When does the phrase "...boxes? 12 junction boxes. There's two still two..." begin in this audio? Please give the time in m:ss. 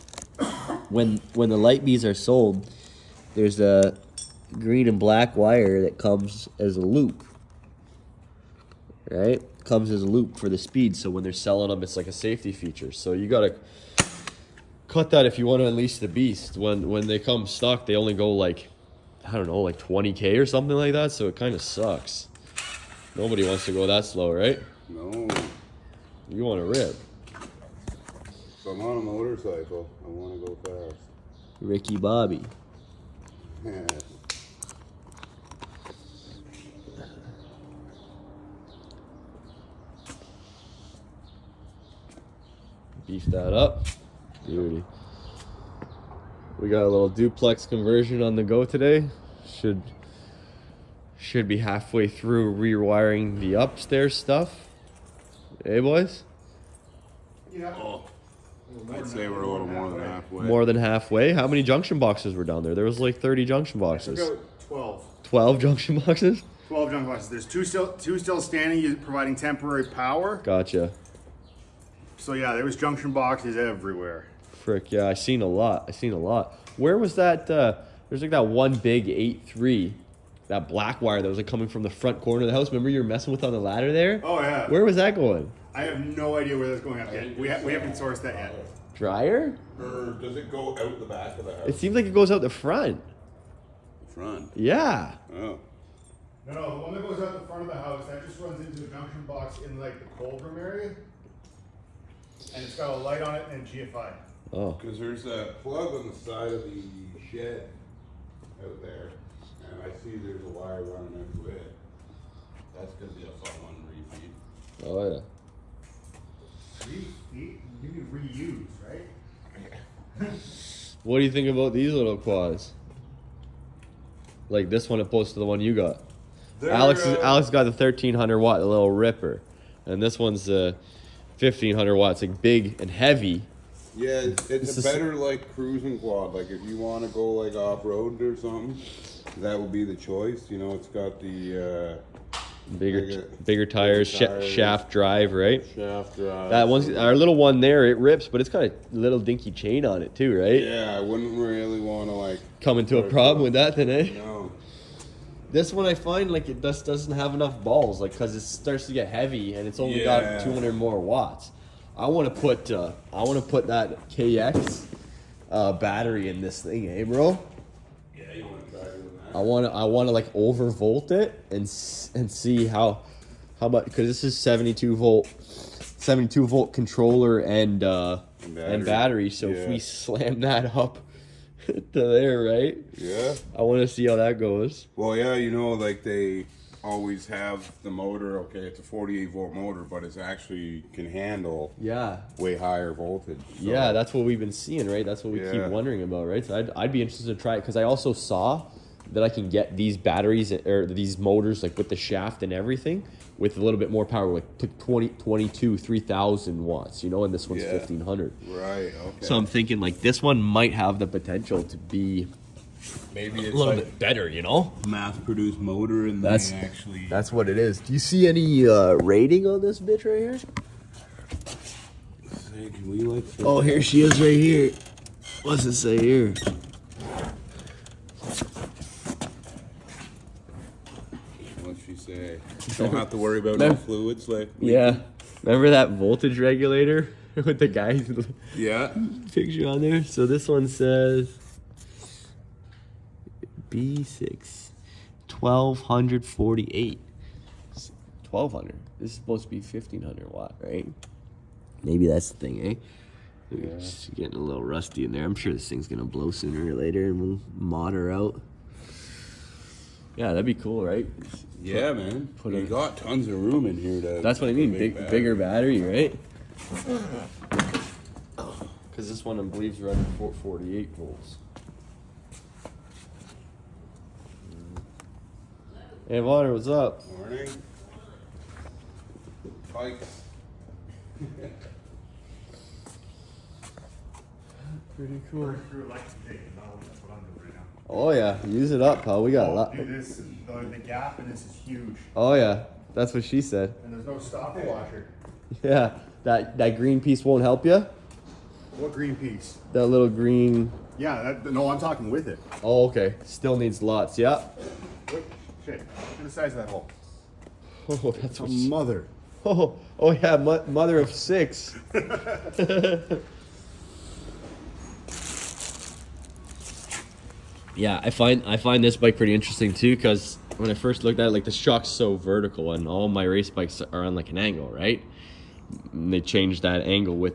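1:05.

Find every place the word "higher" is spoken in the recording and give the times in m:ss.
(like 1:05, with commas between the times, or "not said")
3:12.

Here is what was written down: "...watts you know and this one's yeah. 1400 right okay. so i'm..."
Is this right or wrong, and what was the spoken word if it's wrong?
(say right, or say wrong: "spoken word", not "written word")
wrong: "1500", not "1400".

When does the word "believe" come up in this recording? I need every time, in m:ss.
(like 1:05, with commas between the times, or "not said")
4:29.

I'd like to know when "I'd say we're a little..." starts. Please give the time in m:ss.
0:58.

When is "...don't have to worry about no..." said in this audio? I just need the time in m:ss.
3:52.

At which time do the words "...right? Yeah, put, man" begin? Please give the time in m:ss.
4:20.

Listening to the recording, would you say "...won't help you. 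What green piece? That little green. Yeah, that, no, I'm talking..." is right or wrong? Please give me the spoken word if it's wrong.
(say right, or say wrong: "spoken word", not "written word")
right.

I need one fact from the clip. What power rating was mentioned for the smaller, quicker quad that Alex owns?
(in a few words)
1300 watt.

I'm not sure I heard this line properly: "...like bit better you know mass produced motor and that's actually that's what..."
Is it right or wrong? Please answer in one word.
right.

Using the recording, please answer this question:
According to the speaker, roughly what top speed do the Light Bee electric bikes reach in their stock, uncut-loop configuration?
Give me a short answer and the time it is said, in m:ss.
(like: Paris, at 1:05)
20K, at 0:19.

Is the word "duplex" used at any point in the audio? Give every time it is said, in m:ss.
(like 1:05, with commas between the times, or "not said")
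0:47.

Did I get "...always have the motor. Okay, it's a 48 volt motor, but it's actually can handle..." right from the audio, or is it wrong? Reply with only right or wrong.
right.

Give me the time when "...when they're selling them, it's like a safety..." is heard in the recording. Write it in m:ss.
0:11.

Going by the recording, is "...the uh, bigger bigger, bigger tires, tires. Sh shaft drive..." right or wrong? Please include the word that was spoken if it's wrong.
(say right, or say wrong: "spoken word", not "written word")
right.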